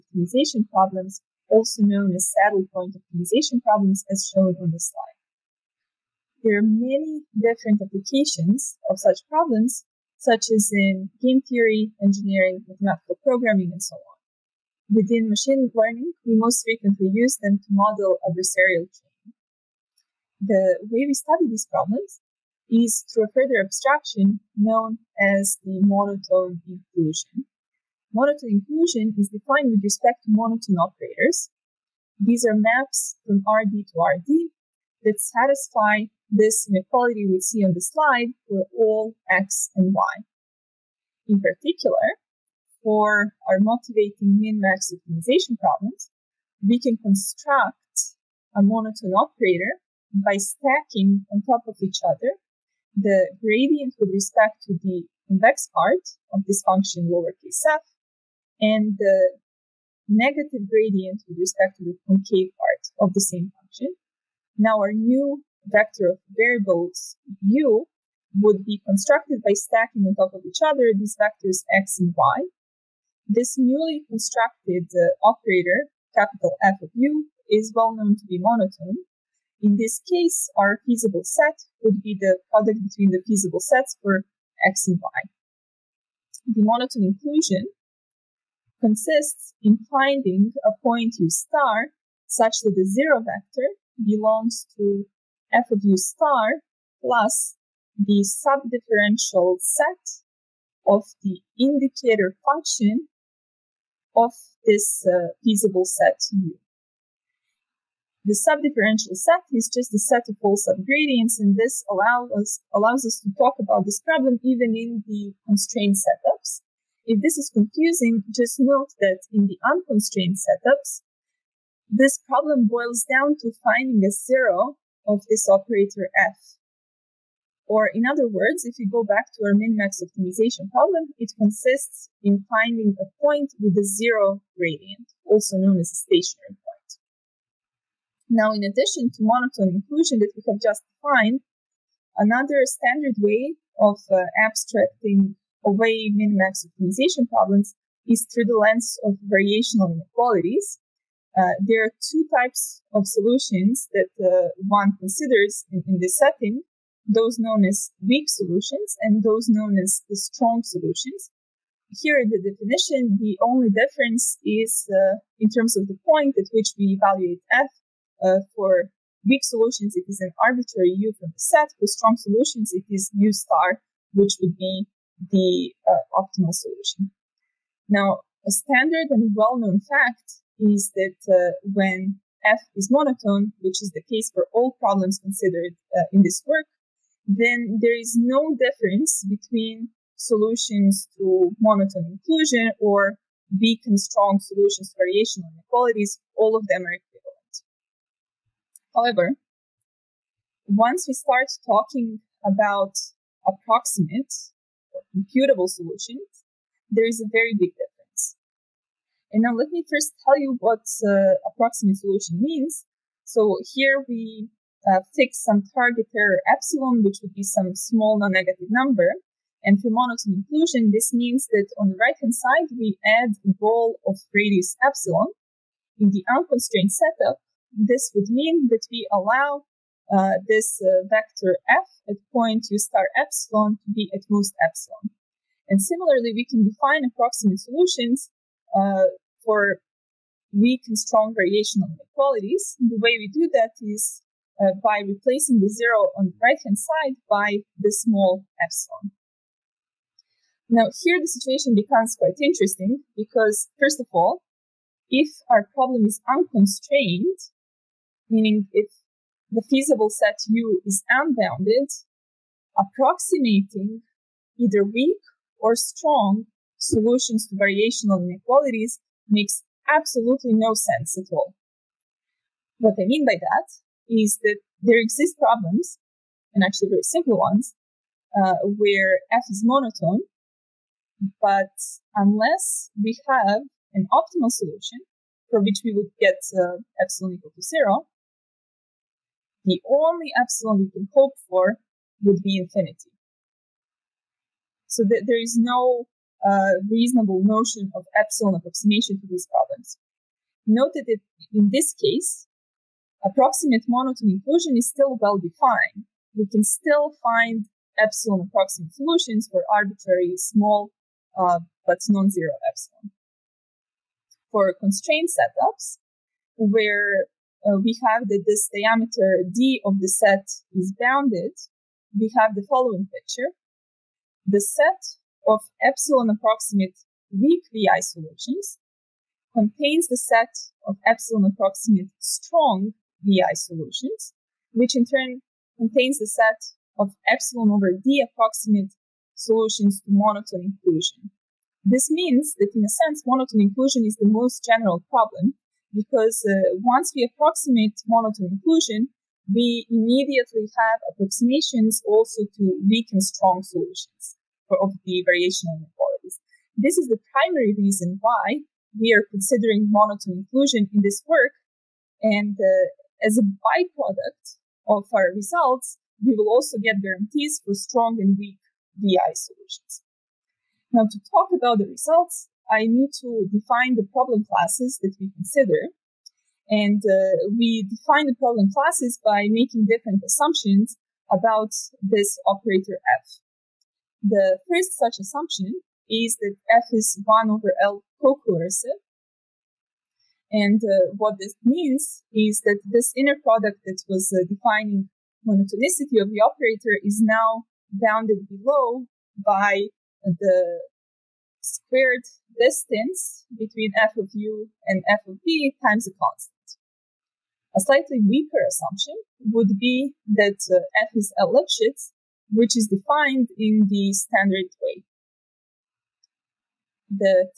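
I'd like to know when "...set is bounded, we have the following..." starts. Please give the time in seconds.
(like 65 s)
320 s.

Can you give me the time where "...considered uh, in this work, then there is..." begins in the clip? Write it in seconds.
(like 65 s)
185 s.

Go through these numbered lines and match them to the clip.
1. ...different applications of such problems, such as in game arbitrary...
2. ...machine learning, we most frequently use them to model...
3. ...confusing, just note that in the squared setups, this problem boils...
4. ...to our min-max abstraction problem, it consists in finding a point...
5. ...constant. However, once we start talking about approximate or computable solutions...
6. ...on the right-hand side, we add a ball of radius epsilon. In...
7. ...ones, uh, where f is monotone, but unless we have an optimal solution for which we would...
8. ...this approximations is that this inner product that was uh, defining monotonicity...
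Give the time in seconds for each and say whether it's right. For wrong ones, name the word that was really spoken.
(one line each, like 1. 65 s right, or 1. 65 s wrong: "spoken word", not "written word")
1. 7 s wrong: "theory", not "arbitrary"
2. 15 s right
3. 117 s wrong: "unconstrained", not "squared"
4. 129 s wrong: "optimization", not "abstraction"
5. 196 s wrong: "equivalent", not "constant"
6. 221 s right
7. 277 s right
8. 391 s wrong: "means", not "approximations".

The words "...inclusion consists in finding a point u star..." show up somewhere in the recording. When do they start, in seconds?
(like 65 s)
87 s.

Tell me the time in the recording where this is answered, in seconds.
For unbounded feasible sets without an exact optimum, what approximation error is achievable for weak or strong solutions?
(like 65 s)
292 s.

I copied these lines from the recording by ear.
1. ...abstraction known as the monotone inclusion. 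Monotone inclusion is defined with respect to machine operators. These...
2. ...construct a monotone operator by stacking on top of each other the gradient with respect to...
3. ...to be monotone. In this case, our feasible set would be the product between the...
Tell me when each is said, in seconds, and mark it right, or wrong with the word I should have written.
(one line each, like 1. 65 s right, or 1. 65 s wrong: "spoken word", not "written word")
1. 23 s wrong: "monotone", not "machine"
2. 46 s right
3. 78 s right.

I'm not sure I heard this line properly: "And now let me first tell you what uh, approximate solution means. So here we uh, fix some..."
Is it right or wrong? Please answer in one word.
right.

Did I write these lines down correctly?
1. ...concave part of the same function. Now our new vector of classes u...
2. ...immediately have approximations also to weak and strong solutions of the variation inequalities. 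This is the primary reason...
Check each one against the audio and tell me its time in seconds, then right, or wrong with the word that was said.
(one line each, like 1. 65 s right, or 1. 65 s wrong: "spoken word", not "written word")
1. 62 s wrong: "variables", not "classes"
2. 349 s right.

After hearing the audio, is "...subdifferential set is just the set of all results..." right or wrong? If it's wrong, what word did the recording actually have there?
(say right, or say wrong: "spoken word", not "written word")
wrong: "subgradients", not "results".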